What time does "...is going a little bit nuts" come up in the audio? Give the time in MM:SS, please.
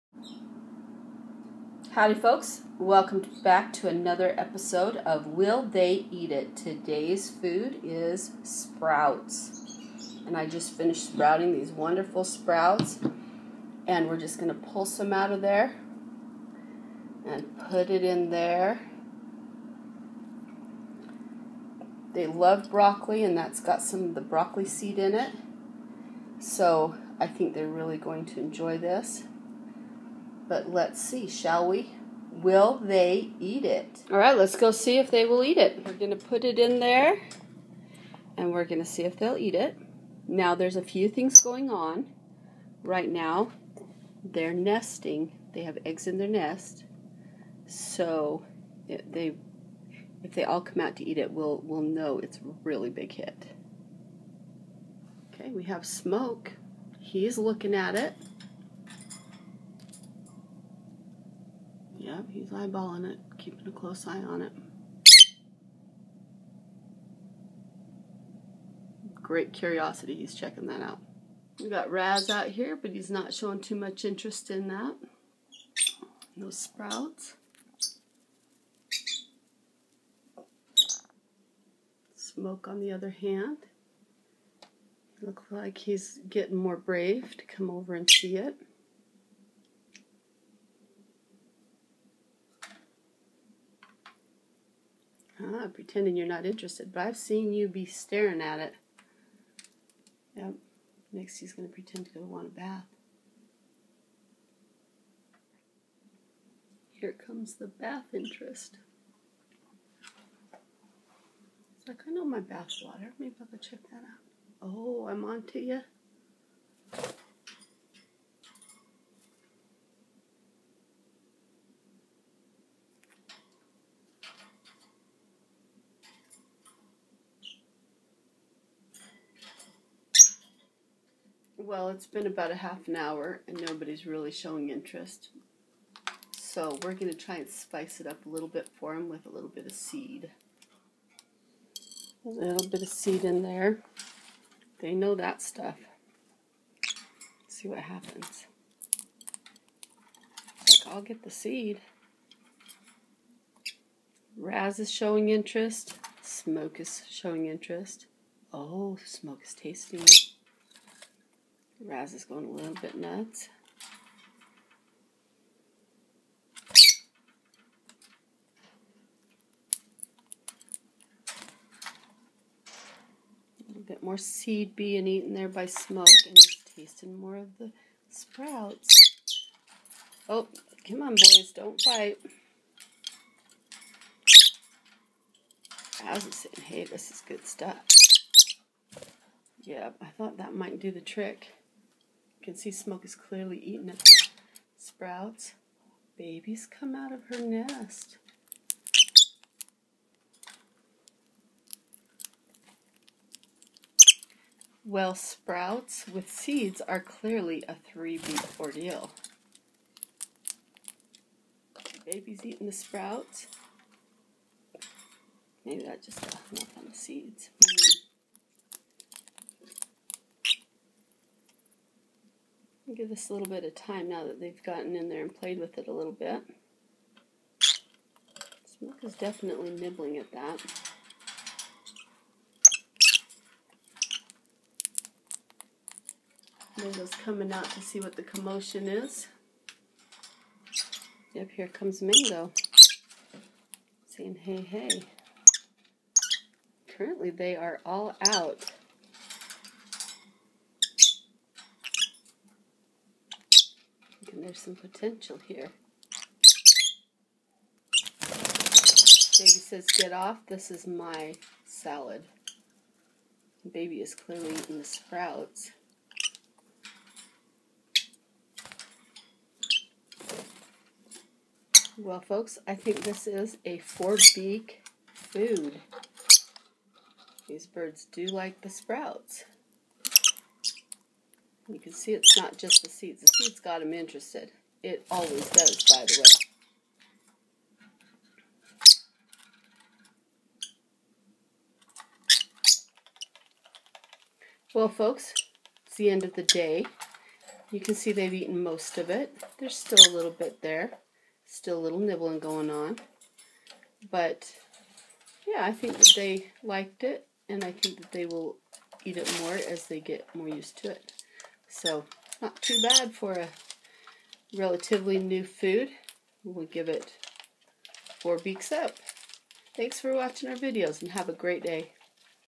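02:42.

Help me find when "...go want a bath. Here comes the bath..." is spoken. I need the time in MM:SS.
01:42.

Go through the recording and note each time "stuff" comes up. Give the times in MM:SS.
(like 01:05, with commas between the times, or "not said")
02:25, 03:07.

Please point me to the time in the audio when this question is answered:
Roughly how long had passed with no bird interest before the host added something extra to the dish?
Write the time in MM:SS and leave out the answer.
02:12.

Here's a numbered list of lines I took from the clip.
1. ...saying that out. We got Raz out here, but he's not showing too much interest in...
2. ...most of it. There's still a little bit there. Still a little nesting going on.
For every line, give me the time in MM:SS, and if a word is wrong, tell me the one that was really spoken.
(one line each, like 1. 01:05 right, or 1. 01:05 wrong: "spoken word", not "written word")
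1. 01:10 wrong: "checking", not "saying"
2. 04:58 wrong: "nibbling", not "nesting".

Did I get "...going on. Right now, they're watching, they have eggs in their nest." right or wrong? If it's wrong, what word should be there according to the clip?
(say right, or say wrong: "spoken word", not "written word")
wrong: "nesting", not "watching".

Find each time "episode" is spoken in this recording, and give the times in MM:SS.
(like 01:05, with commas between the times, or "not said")
00:04.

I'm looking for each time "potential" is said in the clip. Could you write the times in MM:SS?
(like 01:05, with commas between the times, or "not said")
04:14.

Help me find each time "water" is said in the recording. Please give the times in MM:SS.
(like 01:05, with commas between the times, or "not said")
01:52.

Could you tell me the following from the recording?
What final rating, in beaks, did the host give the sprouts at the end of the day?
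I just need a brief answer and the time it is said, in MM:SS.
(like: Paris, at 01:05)
4 beaks, at 05:18.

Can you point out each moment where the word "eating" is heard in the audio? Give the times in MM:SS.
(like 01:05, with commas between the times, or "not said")
03:13, 03:32, 04:24.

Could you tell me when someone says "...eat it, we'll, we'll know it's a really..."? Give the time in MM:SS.
00:51.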